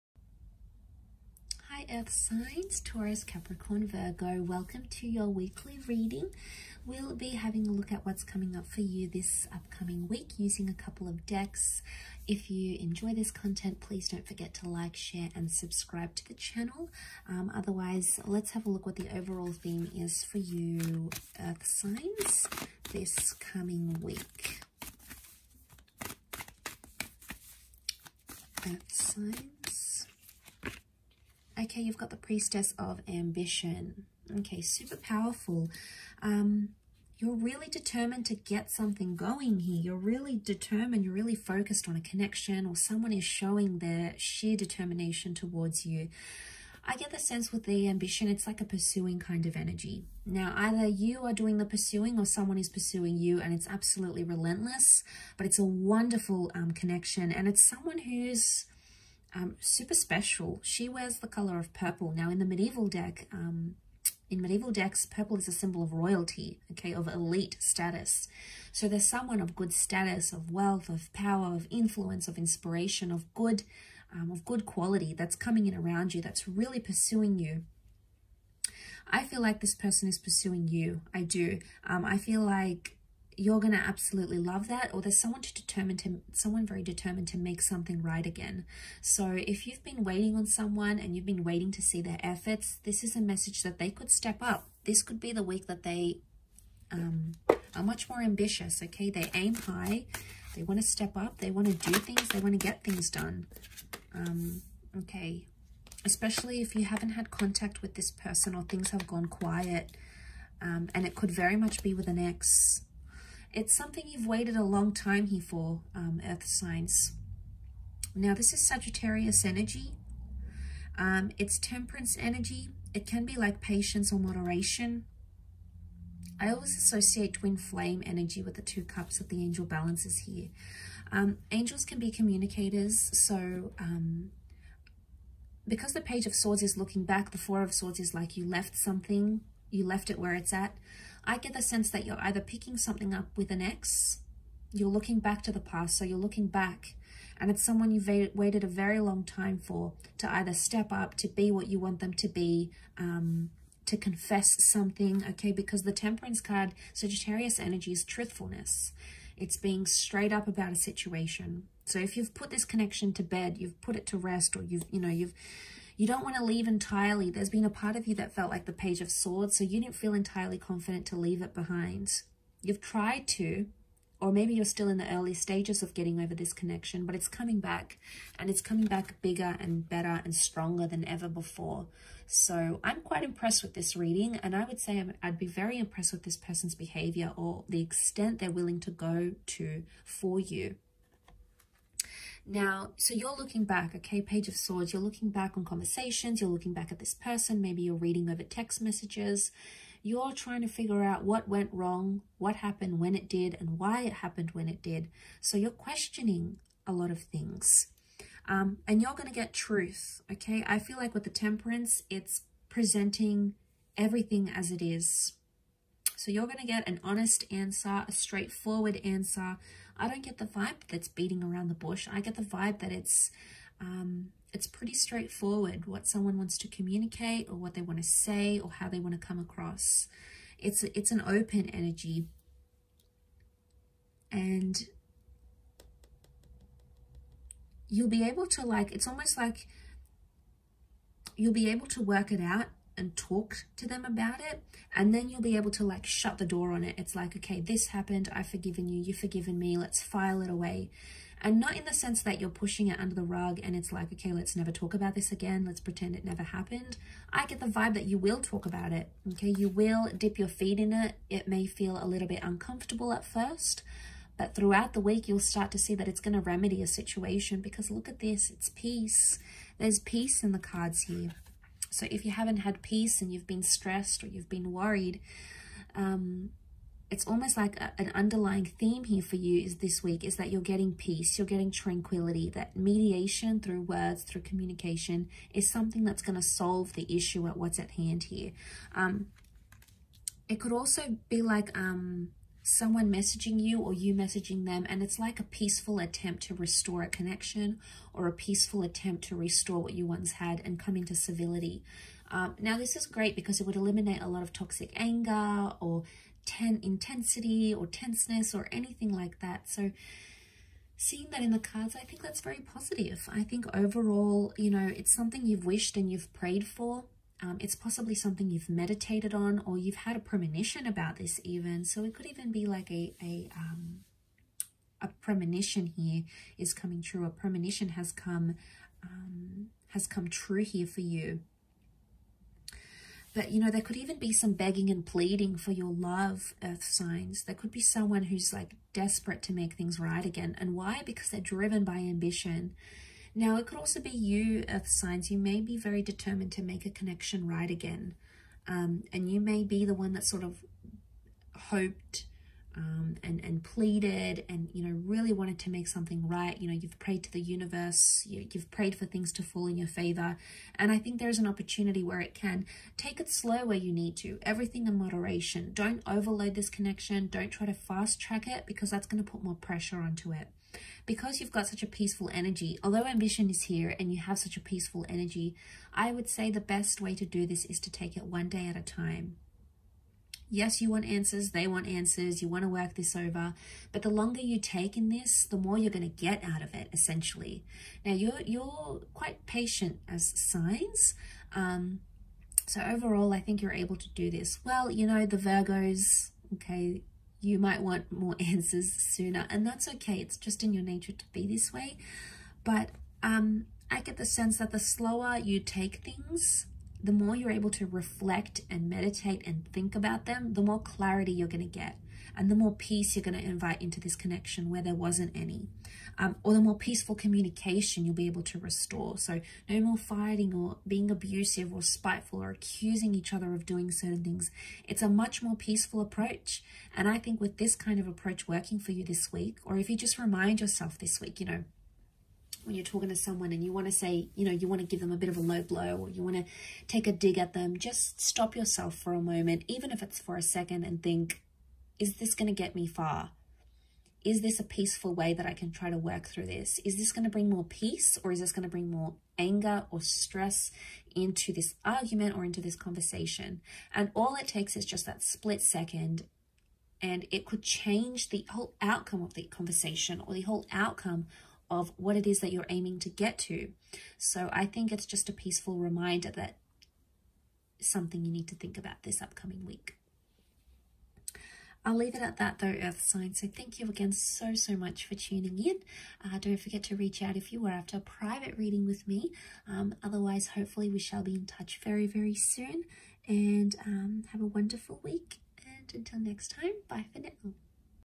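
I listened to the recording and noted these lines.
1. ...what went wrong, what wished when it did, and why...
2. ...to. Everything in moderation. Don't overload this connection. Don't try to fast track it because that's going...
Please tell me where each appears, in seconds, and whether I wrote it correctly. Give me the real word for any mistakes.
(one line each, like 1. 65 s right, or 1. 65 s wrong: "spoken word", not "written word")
1. 201 s wrong: "happened", not "wished"
2. 364 s right.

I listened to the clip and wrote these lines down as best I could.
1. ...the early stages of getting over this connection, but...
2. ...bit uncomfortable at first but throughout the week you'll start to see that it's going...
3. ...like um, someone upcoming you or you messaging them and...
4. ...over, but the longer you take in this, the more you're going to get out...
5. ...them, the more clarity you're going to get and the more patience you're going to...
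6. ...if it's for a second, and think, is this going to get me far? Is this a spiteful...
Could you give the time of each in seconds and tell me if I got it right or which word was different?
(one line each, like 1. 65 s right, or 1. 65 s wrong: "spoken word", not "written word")
1. 174 s right
2. 262 s right
3. 291 s wrong: "messaging", not "upcoming"
4. 383 s right
5. 410 s wrong: "peace", not "patience"
6. 439 s wrong: "peaceful", not "spiteful".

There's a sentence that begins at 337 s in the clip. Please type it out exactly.
There could be someone who's like desperate to make things right again.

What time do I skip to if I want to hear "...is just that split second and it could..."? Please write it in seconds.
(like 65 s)
454 s.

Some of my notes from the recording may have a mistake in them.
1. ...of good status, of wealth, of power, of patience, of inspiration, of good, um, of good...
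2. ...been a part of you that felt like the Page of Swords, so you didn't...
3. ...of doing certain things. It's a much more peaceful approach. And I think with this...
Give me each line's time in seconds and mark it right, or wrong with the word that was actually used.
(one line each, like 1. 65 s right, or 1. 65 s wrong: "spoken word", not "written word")
1. 69 s wrong: "influence", not "patience"
2. 167 s right
3. 423 s right.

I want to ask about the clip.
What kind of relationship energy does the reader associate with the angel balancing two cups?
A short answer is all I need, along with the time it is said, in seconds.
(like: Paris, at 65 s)
Twin flame, at 127 s.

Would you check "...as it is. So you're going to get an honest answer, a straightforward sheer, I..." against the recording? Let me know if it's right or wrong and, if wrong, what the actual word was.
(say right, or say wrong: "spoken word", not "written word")
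wrong: "answer", not "sheer".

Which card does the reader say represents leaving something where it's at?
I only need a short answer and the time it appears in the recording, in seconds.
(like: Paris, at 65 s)
Four of Swords, at 137 s.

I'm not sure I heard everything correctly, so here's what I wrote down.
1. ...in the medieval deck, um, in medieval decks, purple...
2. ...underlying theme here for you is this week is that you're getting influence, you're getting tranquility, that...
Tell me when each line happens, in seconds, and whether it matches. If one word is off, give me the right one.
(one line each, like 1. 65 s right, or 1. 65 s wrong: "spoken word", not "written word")
1. 62 s right
2. 278 s wrong: "peace", not "influence".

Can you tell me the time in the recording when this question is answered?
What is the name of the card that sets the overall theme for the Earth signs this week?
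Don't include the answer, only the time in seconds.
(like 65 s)
32 s.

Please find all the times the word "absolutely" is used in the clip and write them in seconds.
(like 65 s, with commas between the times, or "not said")
53 s, 83 s.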